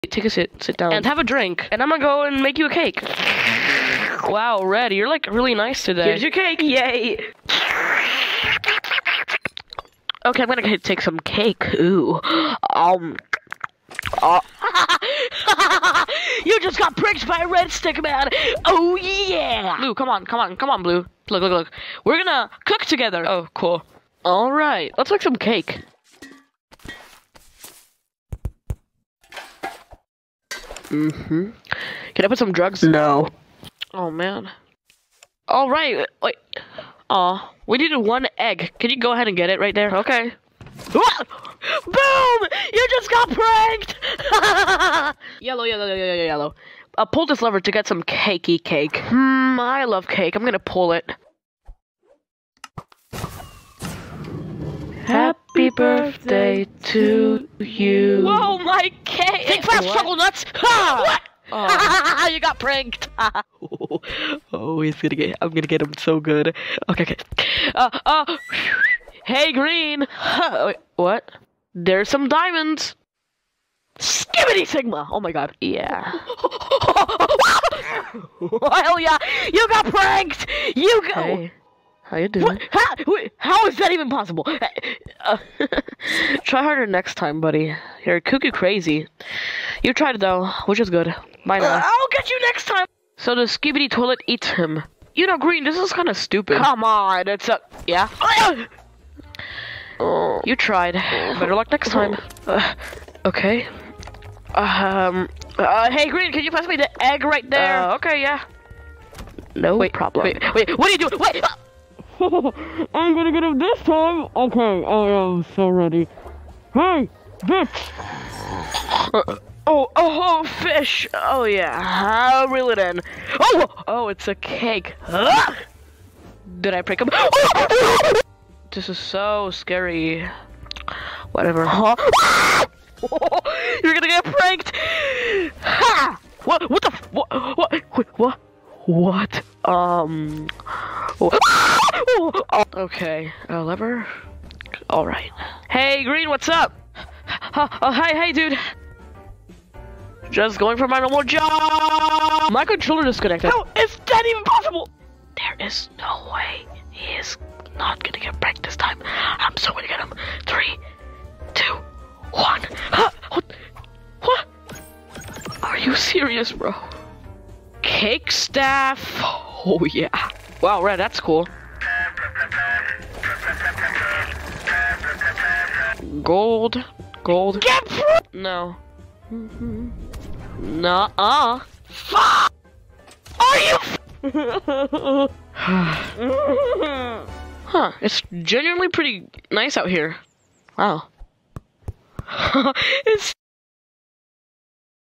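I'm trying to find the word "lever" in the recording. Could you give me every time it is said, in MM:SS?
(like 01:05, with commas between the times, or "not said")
00:47, 02:23.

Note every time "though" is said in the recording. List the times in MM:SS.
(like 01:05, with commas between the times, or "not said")
01:30.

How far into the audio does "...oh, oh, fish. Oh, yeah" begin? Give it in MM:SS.
01:59.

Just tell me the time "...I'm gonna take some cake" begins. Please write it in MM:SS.
00:10.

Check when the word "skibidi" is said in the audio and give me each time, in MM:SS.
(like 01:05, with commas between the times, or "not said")
01:13, 01:33.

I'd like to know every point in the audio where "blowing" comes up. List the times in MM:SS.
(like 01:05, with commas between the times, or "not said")
not said.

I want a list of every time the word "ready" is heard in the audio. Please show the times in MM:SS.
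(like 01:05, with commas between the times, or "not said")
01:55.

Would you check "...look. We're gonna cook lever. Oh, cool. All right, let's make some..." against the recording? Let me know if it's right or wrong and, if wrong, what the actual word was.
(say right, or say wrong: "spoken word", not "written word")
wrong: "together", not "lever".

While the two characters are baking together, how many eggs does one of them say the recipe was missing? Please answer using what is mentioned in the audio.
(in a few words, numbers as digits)
1.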